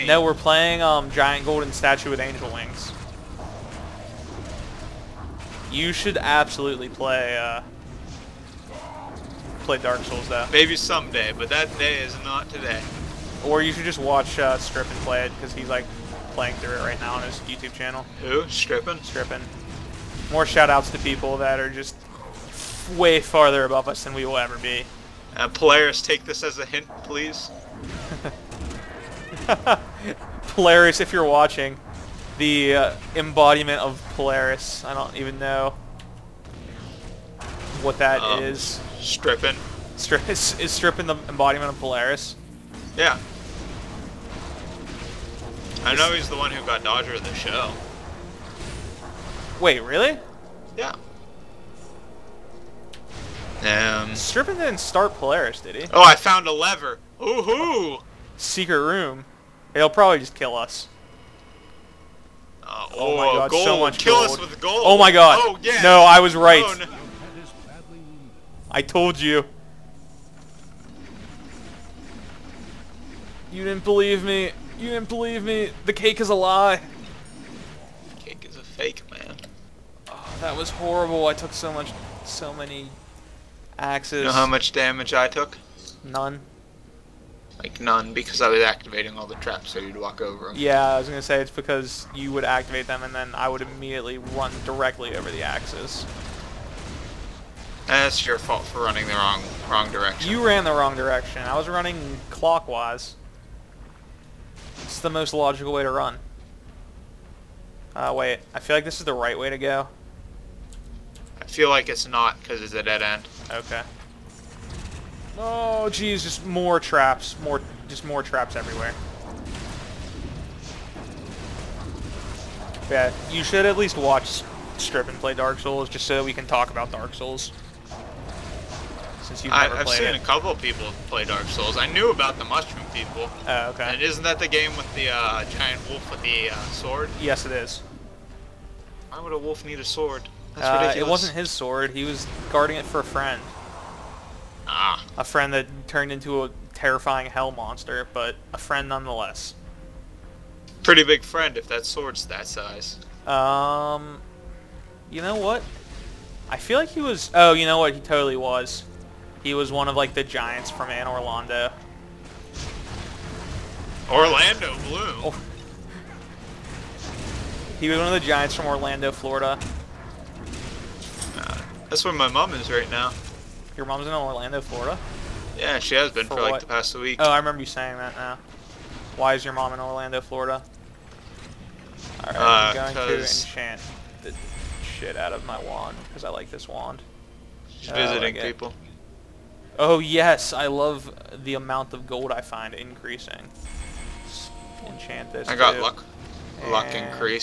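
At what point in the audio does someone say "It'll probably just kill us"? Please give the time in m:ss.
0:59.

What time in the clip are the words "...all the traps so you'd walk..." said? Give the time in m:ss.
1:29.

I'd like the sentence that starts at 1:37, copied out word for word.
That's eh, your fault for running the wrong wrong direction.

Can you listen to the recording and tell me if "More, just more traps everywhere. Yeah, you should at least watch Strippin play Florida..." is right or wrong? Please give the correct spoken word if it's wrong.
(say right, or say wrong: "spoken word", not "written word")
wrong: "Dark", not "Florida".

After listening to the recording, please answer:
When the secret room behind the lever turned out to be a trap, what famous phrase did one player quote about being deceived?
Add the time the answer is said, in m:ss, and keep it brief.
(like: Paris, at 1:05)
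The cake is a lie, at 1:15.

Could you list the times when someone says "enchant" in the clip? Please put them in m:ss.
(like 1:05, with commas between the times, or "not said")
3:03, 3:14.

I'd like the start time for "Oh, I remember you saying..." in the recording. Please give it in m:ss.
2:57.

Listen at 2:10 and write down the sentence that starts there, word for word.
a couple people play Dark Souls.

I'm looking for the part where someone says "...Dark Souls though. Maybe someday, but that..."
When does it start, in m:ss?
0:09.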